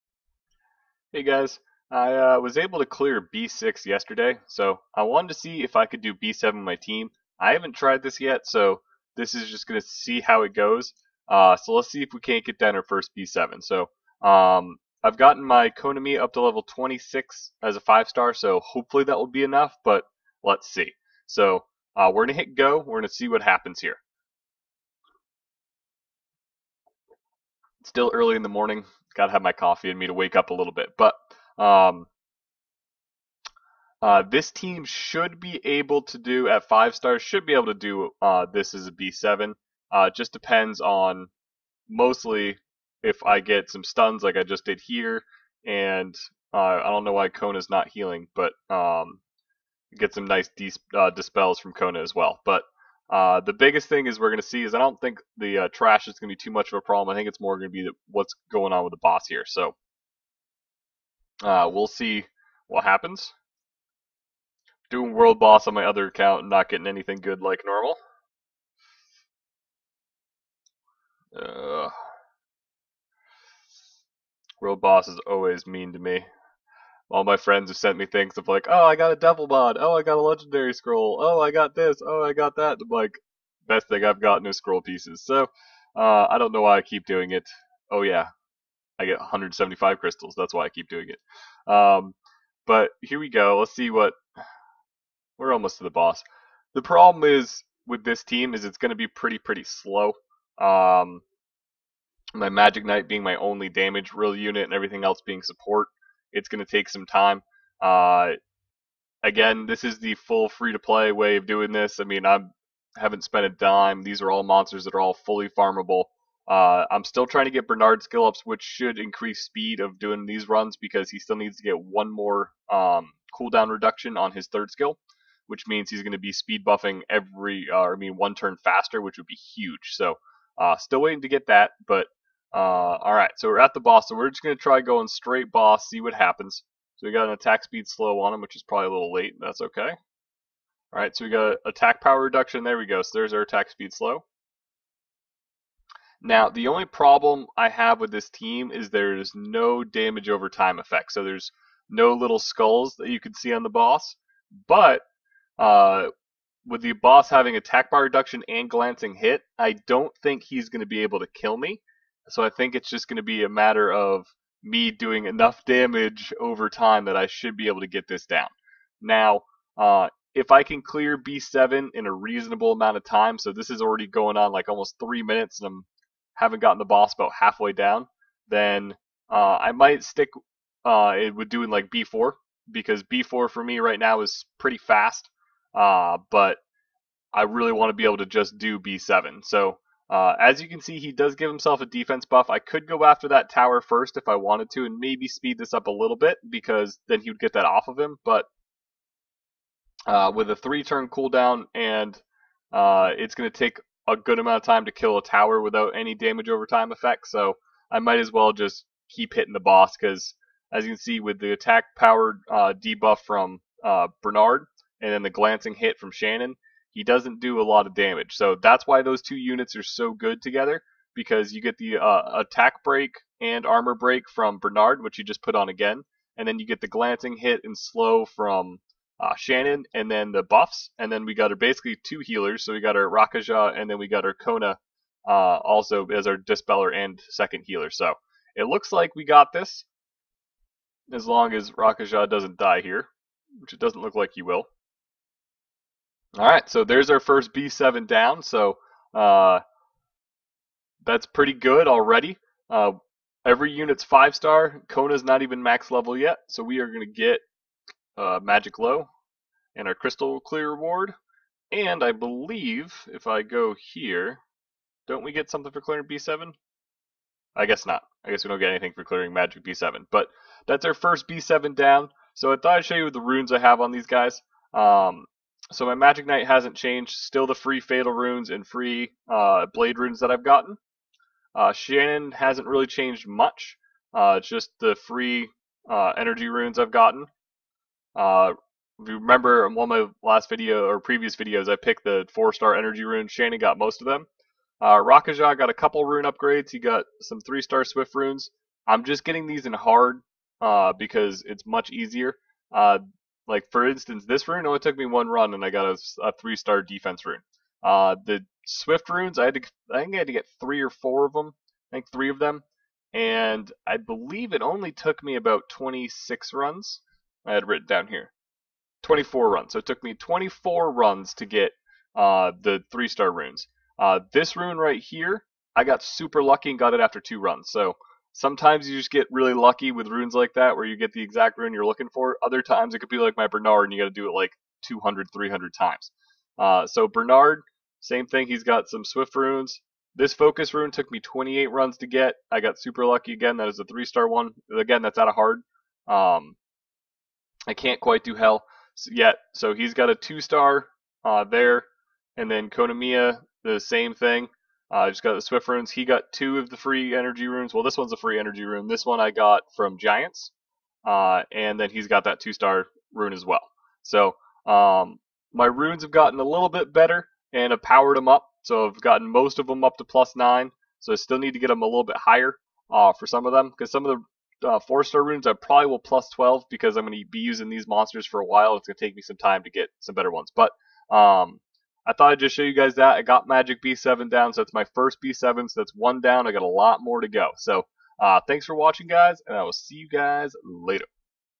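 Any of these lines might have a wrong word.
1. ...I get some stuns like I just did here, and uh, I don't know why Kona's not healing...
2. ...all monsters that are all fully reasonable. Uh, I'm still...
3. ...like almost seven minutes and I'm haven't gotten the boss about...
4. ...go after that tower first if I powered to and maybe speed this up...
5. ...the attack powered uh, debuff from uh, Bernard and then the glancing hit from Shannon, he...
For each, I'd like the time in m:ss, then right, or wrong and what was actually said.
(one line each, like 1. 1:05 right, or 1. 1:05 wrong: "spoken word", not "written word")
1. 0:43 right
2. 1:54 wrong: "farmable", not "reasonable"
3. 2:54 wrong: "three", not "seven"
4. 3:12 wrong: "wanted", not "powered"
5. 3:31 right.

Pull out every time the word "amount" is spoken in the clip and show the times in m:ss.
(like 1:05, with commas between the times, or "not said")
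2:52, 3:24.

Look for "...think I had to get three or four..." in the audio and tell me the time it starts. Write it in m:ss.
5:10.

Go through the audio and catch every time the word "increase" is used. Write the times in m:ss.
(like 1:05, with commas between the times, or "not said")
1:58.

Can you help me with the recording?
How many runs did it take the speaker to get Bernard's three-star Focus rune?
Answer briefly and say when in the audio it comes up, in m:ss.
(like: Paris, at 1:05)
28, at 5:41.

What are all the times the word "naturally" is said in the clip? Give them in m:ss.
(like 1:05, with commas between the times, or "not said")
not said.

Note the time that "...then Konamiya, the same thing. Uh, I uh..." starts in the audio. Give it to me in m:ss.
5:52.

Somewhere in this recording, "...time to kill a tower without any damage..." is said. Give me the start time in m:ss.
3:24.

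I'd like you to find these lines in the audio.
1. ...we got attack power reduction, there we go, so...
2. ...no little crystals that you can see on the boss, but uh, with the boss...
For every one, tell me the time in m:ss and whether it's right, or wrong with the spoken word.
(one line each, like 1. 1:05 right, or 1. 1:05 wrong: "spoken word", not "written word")
1. 2:21 right
2. 2:31 wrong: "skulls", not "crystals".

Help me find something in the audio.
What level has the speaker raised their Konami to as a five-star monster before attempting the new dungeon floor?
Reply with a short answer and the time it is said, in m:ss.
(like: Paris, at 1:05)
26, at 0:16.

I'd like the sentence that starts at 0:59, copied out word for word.
So uh, we'll see what happens.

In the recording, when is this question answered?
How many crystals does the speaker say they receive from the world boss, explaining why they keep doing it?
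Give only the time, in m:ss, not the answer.
1:29.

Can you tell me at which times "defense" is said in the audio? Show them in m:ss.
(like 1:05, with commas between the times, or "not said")
3:11, 5:06.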